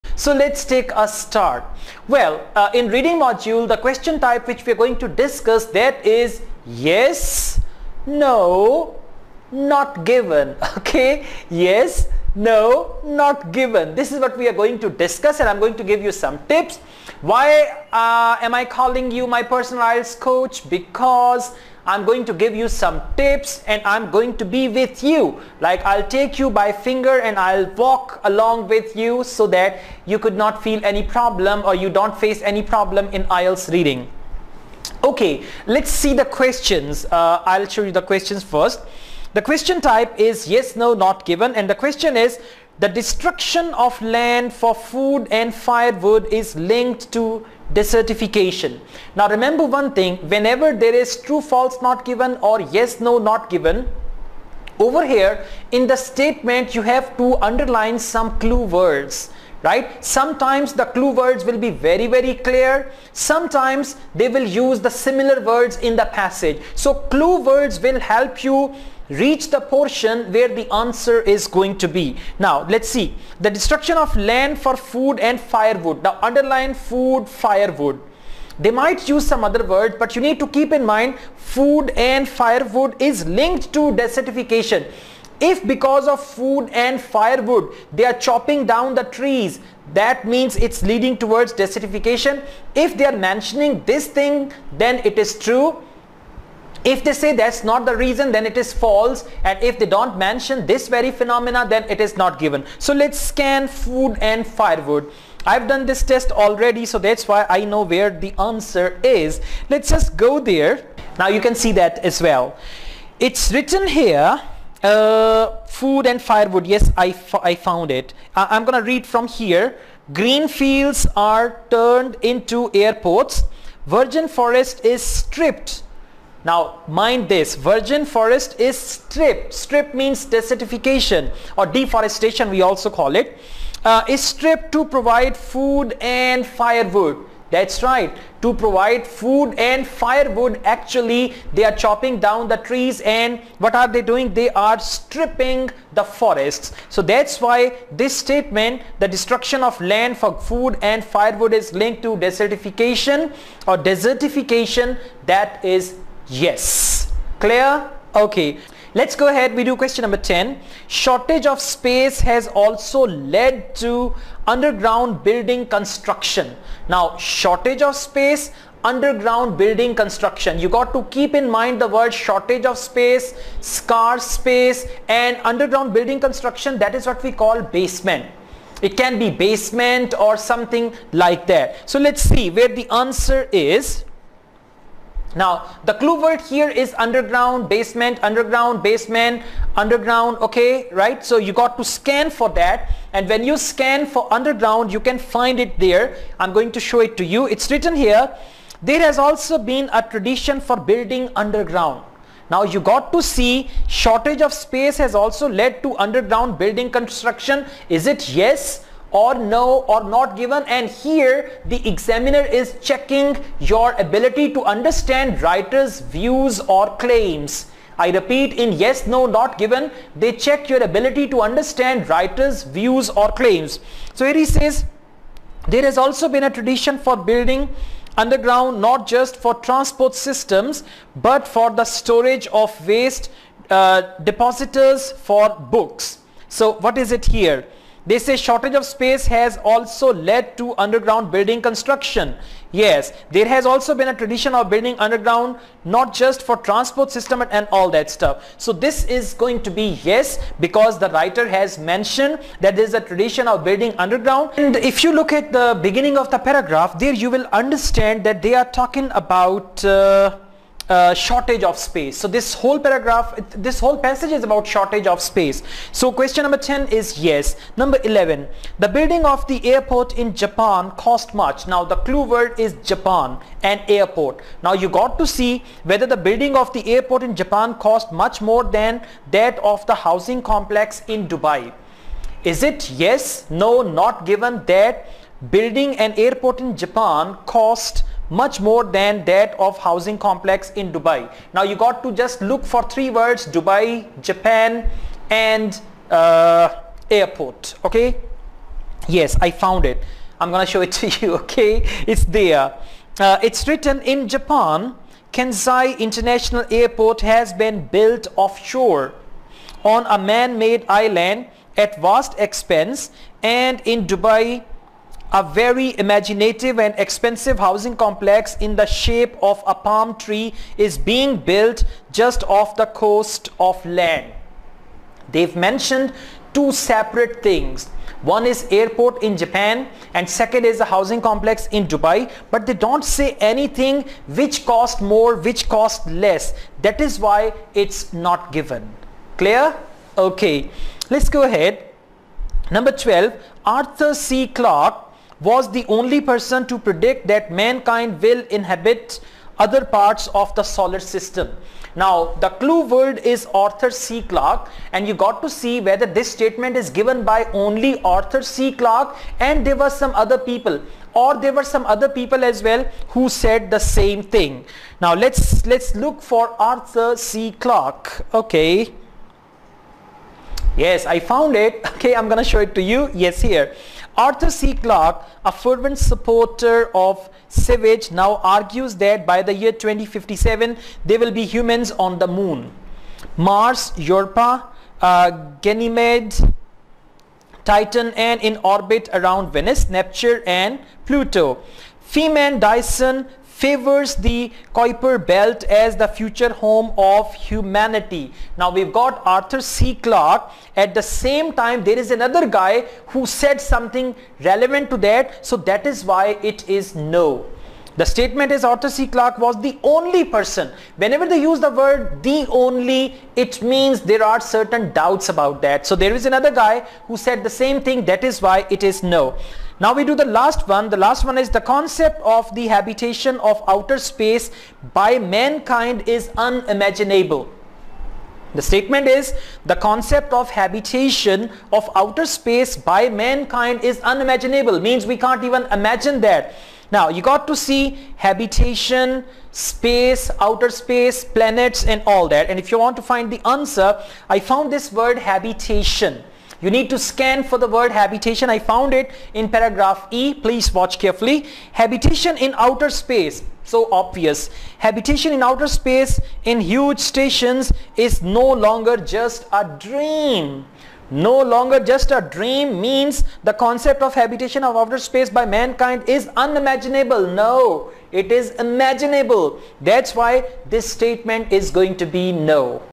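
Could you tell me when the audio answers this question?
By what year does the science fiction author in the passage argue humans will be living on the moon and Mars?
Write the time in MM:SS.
06:19.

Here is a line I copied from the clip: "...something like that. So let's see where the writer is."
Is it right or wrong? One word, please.
wrong.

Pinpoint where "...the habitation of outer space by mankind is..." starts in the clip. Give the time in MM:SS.
07:02.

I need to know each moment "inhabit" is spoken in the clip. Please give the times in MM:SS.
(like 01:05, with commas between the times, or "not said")
05:48.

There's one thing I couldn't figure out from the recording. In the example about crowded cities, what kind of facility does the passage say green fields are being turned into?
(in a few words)
airports.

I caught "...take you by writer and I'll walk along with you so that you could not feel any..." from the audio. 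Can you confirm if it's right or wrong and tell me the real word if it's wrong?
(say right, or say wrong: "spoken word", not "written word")
wrong: "finger", not "writer".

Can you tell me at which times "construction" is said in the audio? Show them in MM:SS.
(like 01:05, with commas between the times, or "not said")
02:45, 02:49, 02:56, 03:26, 04:01.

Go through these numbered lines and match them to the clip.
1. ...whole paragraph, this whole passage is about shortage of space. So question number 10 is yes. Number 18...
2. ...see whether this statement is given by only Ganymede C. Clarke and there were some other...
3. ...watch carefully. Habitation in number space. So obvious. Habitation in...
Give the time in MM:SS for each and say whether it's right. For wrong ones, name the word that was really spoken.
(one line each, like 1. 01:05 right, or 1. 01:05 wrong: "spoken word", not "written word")
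1. 04:22 wrong: "11", not "18"
2. 05:55 wrong: "Arthur", not "Ganymede"
3. 07:30 wrong: "outer", not "number".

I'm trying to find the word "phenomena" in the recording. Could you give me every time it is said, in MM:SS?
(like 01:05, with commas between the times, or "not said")
01:41.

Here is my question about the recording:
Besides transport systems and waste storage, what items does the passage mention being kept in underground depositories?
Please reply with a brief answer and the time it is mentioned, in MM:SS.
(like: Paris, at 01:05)
books, at 03:55.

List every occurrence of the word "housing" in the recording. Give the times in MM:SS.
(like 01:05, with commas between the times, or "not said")
04:39, 04:49, 05:17, 05:30.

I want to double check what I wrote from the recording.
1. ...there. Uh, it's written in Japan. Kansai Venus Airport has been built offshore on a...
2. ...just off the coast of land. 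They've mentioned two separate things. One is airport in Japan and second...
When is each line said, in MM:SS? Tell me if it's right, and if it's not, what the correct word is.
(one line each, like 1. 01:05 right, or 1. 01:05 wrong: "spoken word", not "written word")
1. 05:02 wrong: "International", not "Venus"
2. 05:22 right.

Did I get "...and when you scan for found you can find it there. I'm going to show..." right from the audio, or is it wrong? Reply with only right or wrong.
wrong.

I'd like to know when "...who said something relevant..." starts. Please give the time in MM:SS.
06:43.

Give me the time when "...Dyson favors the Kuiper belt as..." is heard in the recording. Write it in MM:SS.
06:32.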